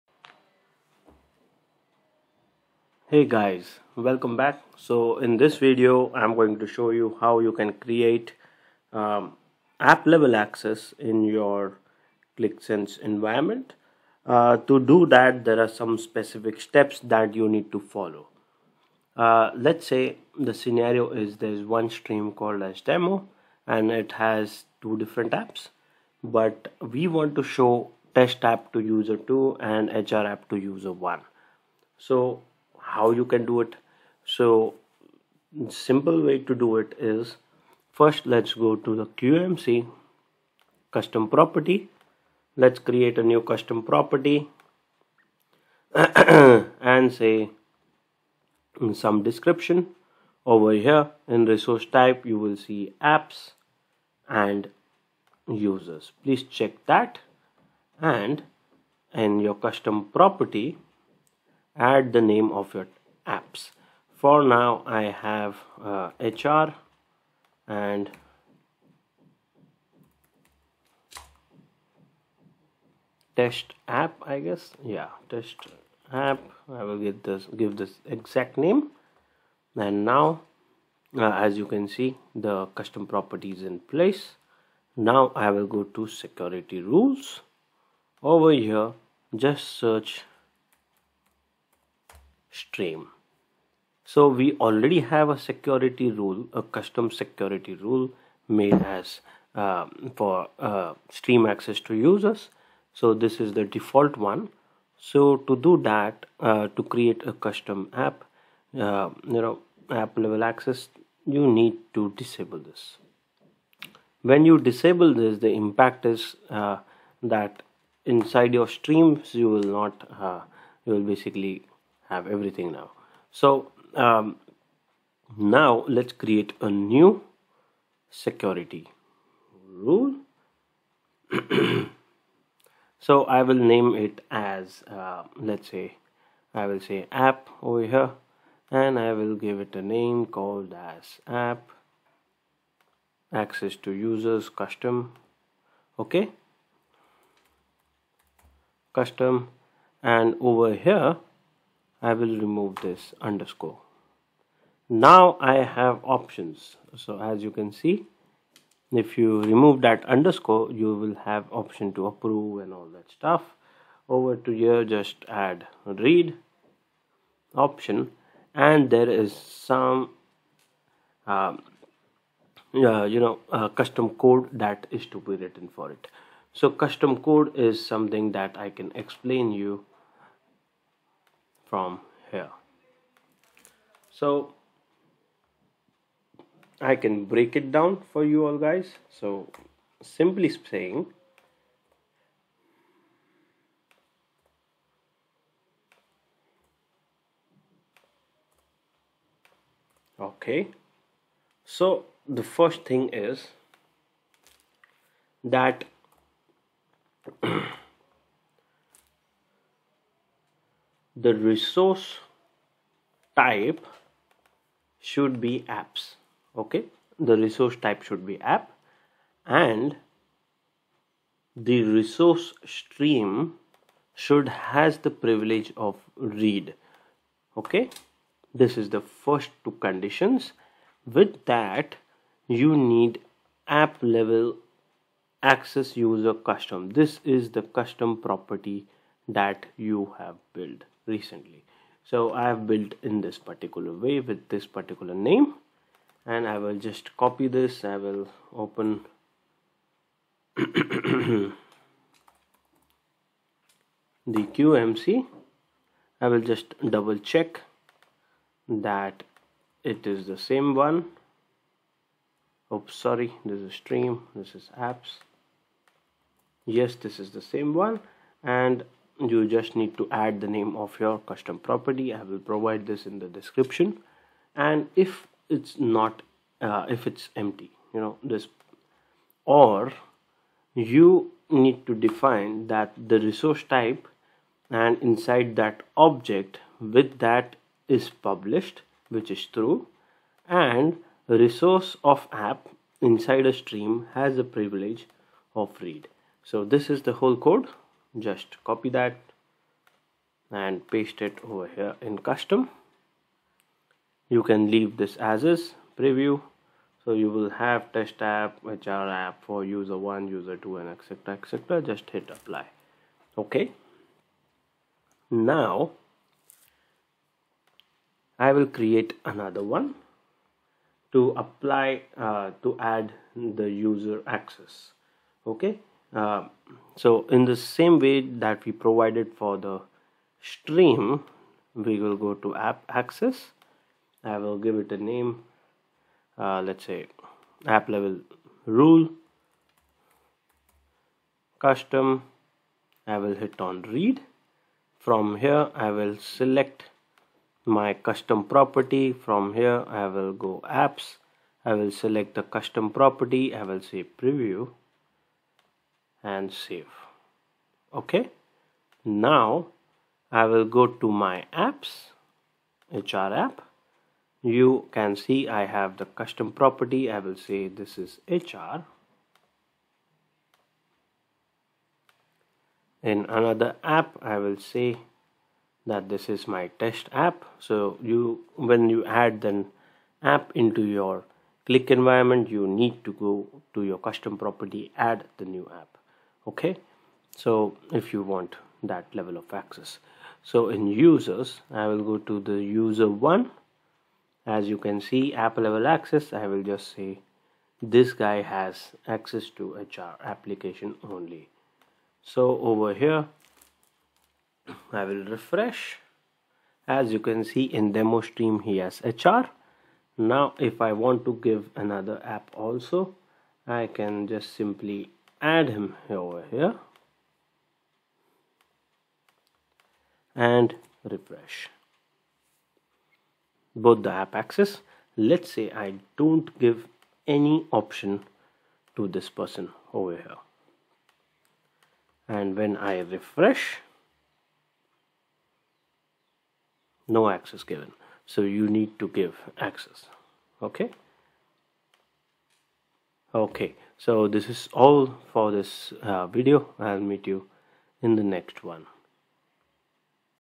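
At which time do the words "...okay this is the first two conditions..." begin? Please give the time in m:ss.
3:47.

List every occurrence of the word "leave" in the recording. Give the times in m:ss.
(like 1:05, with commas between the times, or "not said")
5:04.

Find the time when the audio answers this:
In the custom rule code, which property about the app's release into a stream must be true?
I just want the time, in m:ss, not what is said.
4:47.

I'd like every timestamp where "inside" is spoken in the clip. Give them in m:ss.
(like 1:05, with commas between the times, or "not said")
1:58, 4:45, 4:53.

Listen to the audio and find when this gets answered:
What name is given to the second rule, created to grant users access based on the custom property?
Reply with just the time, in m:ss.
5:37.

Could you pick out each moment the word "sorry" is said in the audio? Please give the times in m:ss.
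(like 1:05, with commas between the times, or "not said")
4:22.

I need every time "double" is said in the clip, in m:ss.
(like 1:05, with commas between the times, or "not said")
4:16.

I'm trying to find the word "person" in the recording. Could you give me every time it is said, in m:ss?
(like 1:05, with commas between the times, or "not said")
7:09.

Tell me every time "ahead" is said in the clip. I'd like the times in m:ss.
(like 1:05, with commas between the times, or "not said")
not said.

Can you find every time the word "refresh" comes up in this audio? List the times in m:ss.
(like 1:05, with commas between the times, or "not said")
6:45, 7:01, 7:12.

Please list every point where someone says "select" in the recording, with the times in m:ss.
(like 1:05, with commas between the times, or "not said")
5:46, 5:51.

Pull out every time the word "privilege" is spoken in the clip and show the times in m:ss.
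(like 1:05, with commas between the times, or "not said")
3:45, 4:54.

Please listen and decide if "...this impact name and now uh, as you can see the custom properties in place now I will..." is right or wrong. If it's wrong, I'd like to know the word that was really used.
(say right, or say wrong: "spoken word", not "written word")
wrong: "exact", not "impact".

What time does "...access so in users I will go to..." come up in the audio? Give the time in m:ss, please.
6:29.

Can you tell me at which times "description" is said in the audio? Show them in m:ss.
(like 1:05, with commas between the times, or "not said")
0:49, 4:33.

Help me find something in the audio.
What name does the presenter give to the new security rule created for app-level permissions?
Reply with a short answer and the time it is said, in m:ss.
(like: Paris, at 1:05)
app access to users custom, at 2:21.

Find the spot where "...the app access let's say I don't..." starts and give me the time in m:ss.
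7:04.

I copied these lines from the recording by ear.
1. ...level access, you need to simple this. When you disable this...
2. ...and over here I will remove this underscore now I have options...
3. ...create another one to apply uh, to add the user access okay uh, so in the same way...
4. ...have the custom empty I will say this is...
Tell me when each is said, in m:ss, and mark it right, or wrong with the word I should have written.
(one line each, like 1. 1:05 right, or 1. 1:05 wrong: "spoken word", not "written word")
1. 1:50 wrong: "disable", not "simple"
2. 2:30 right
3. 5:18 right
4. 6:05 wrong: "property", not "empty".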